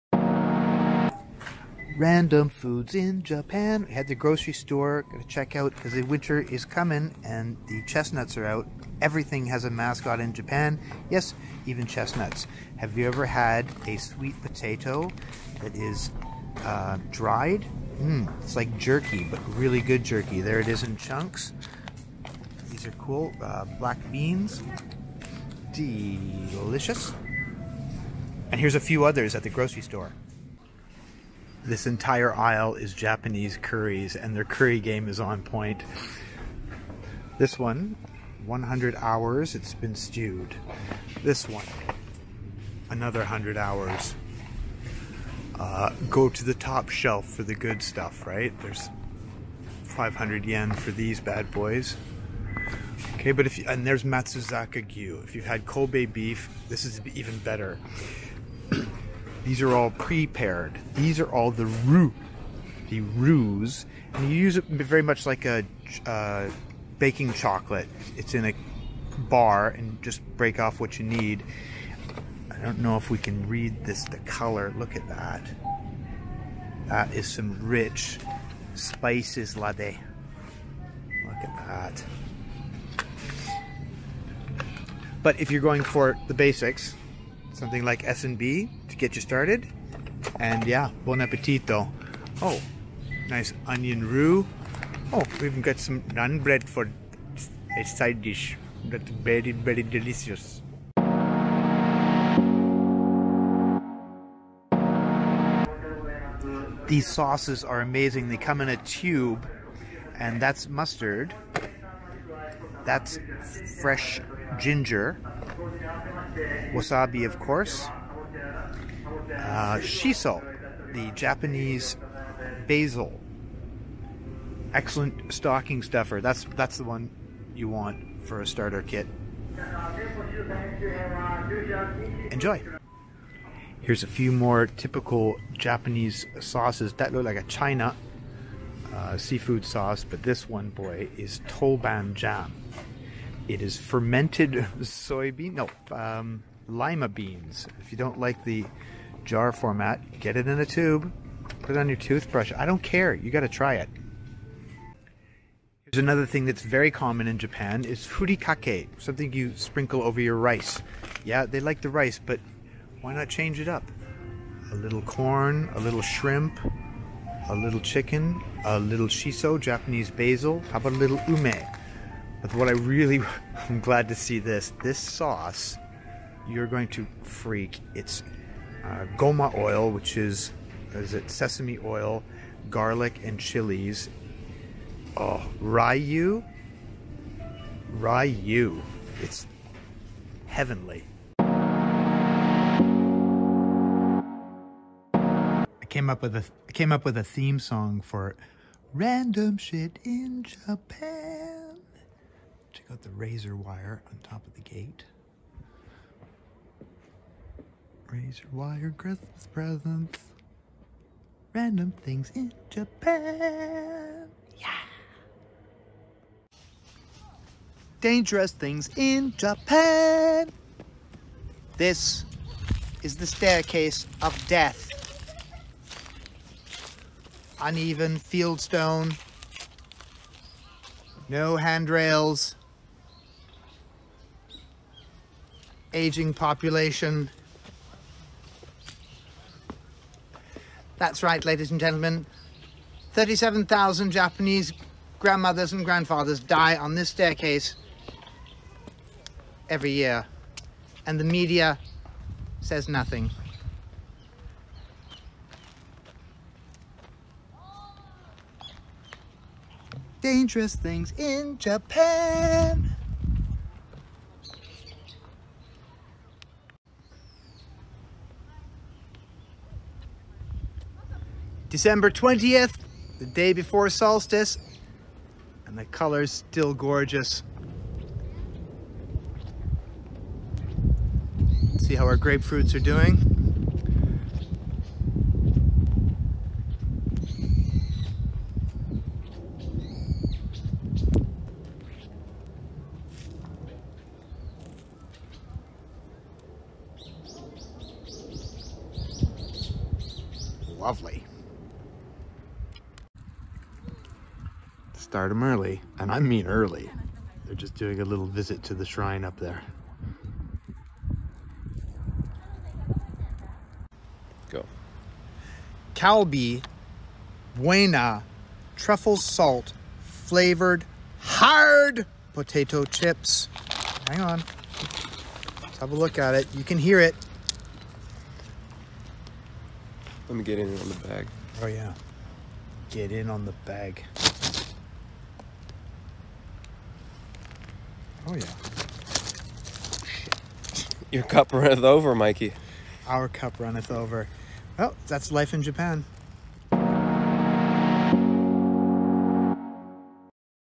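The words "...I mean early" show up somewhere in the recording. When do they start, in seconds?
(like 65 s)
306 s.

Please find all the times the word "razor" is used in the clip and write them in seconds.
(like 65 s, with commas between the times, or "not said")
203 s, 208 s.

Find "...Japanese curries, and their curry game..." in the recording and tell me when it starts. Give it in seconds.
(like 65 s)
32 s.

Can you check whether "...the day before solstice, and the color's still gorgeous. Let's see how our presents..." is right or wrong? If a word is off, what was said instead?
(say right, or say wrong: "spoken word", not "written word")
wrong: "grapefruits", not "presents".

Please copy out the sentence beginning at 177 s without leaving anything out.
It's uh, goma oil, which is, is it sesame oil, garlic, and chilies.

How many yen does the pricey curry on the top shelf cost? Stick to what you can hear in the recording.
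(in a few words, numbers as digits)
500 yen.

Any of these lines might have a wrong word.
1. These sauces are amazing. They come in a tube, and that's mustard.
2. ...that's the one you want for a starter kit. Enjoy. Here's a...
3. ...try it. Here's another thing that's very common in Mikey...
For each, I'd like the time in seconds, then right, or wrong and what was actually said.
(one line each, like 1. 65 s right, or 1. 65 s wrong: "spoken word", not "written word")
1. 106 s right
2. 126 s right
3. 153 s wrong: "Japan", not "Mikey".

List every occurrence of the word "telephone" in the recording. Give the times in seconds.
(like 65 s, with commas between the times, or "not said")
not said.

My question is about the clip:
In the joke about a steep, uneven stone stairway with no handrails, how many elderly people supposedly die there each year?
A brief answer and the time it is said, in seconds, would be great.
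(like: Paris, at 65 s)
37,000, at 243 s.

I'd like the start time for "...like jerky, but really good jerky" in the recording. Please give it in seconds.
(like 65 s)
18 s.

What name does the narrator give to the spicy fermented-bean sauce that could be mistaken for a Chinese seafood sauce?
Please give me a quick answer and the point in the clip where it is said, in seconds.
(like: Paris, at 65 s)
Toban Djan, at 141 s.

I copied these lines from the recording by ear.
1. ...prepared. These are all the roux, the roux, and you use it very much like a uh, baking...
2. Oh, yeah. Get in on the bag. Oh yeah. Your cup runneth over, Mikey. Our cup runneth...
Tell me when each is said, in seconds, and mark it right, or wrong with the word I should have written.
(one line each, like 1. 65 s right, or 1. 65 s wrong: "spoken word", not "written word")
1. 59 s right
2. 331 s right.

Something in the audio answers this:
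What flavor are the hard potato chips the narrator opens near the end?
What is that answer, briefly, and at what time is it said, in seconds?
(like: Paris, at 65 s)
Truffle salt, at 318 s.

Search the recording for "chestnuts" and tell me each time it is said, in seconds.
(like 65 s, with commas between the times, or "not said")
7 s, 11 s.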